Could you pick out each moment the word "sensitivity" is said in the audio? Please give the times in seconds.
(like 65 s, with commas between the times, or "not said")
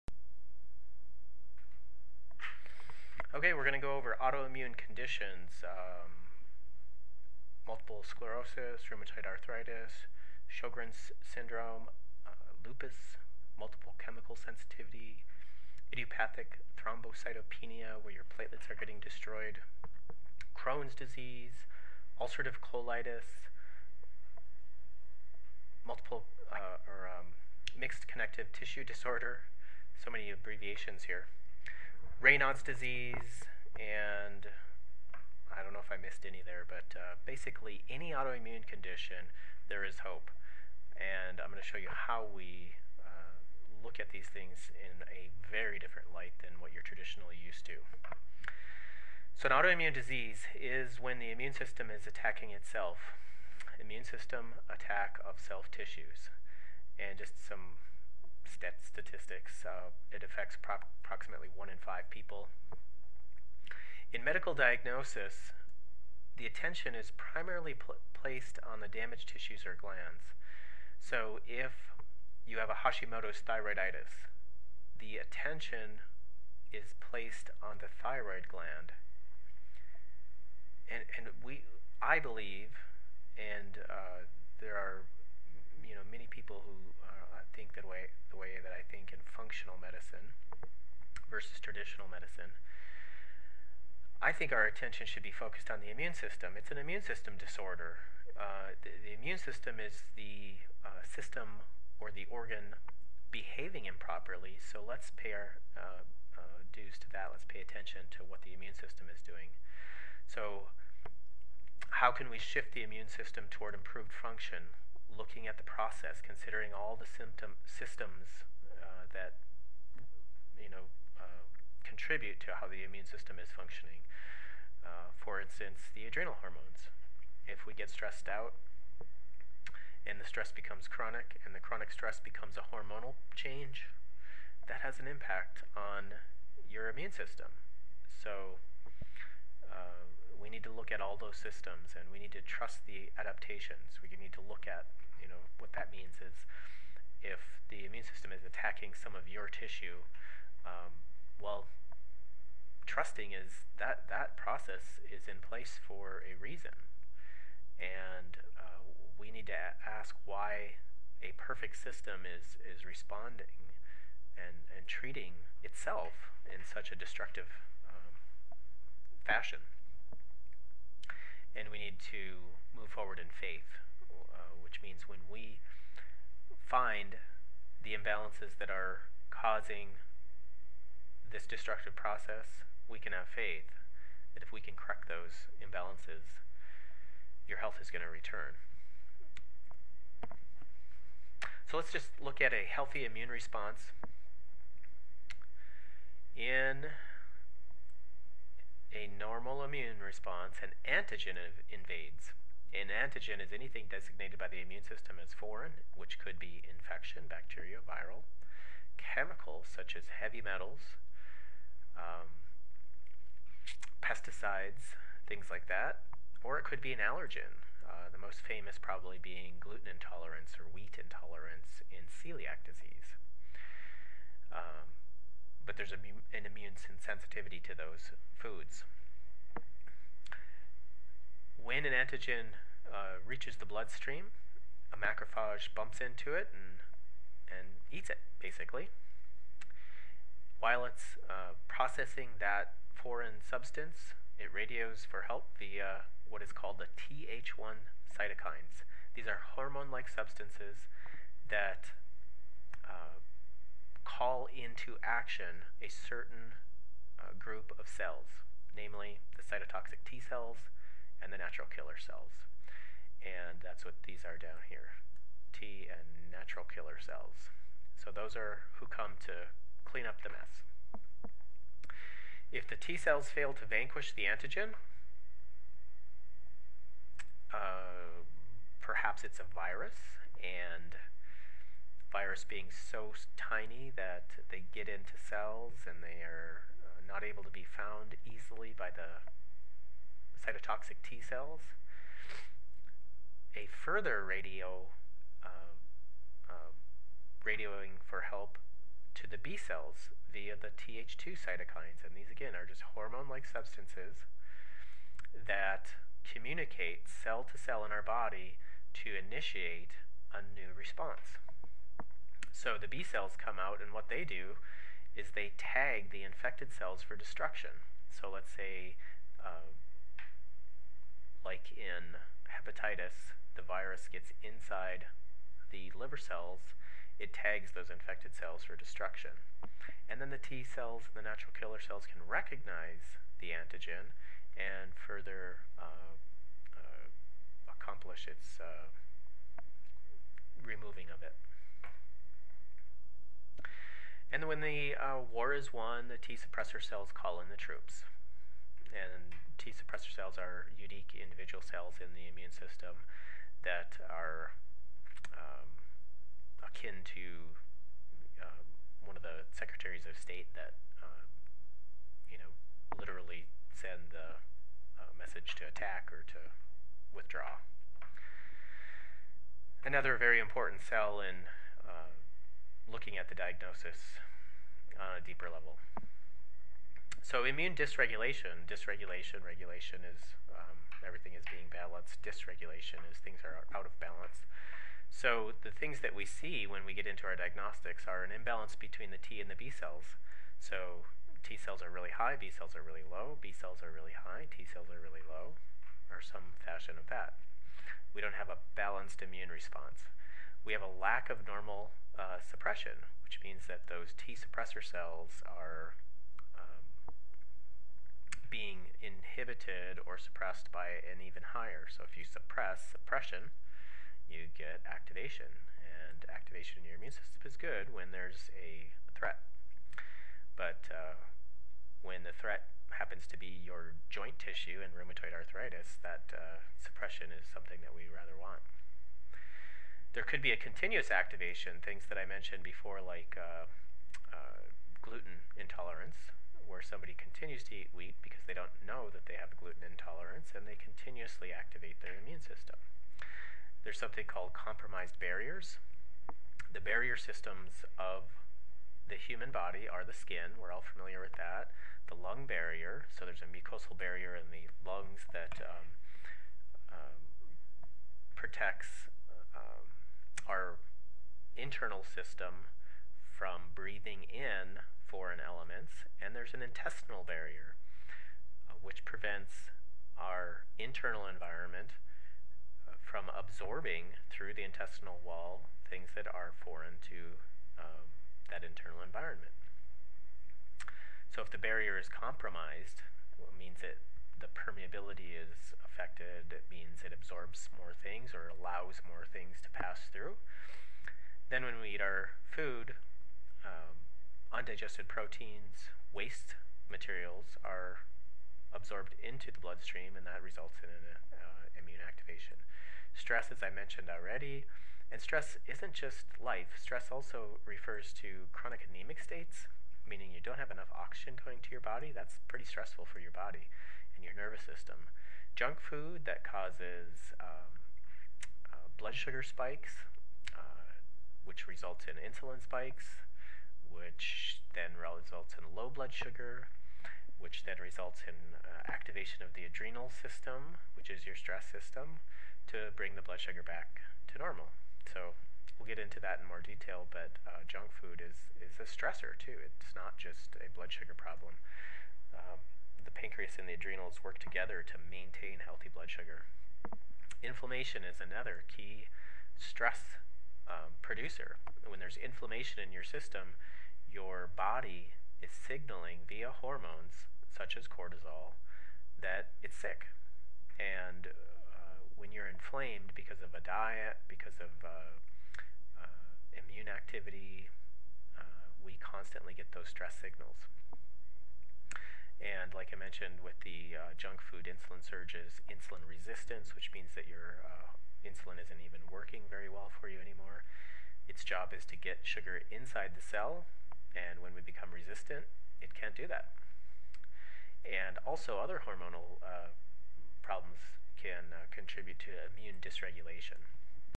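14 s, 227 s.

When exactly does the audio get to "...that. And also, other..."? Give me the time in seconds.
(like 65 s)
586 s.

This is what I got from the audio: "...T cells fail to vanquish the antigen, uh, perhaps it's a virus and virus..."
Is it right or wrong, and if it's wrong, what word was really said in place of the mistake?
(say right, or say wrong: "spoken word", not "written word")
right.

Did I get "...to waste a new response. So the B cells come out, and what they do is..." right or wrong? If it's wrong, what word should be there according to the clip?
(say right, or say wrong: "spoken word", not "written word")
wrong: "initiate", not "waste".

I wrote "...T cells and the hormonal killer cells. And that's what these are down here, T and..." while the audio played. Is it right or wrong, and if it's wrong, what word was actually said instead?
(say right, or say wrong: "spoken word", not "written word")
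wrong: "natural", not "hormonal".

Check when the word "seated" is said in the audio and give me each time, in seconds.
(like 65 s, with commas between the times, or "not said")
not said.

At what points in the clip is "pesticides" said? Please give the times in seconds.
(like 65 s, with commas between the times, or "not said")
214 s.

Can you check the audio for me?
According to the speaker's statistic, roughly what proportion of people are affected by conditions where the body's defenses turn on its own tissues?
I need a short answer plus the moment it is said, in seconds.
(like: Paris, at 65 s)
1 in 5, at 61 s.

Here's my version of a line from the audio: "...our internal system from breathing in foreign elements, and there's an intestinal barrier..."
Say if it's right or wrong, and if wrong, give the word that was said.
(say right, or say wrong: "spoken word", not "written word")
right.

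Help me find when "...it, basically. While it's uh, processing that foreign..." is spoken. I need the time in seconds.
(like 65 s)
238 s.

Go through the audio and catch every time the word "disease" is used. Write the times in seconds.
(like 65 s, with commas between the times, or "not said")
20 s, 32 s, 49 s, 222 s.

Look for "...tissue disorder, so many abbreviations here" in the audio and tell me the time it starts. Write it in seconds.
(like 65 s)
28 s.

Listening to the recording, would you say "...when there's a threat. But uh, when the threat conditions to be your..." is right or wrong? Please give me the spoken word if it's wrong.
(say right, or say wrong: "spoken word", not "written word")
wrong: "happens", not "conditions".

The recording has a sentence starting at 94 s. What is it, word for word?
I think our attention should be focused on the immune system.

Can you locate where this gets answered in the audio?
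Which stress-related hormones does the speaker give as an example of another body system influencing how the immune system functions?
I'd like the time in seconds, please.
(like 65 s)
125 s.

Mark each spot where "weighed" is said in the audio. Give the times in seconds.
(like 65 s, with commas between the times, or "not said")
not said.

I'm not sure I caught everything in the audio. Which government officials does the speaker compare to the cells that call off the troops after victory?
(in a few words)
secretaries of state.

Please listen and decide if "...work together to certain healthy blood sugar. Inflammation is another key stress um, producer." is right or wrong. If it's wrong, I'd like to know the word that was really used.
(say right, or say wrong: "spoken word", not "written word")
wrong: "maintain", not "certain".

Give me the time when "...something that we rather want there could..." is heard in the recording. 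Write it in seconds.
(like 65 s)
427 s.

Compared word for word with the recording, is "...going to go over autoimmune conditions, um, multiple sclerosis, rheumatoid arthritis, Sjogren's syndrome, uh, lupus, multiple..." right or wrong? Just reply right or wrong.
right.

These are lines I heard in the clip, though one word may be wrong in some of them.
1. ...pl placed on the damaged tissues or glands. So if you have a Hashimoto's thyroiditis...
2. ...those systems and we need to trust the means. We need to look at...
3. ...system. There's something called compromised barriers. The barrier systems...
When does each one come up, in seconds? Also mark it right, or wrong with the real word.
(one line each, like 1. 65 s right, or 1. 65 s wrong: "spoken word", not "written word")
1. 67 s right
2. 141 s wrong: "adaptations", not "means"
3. 442 s right.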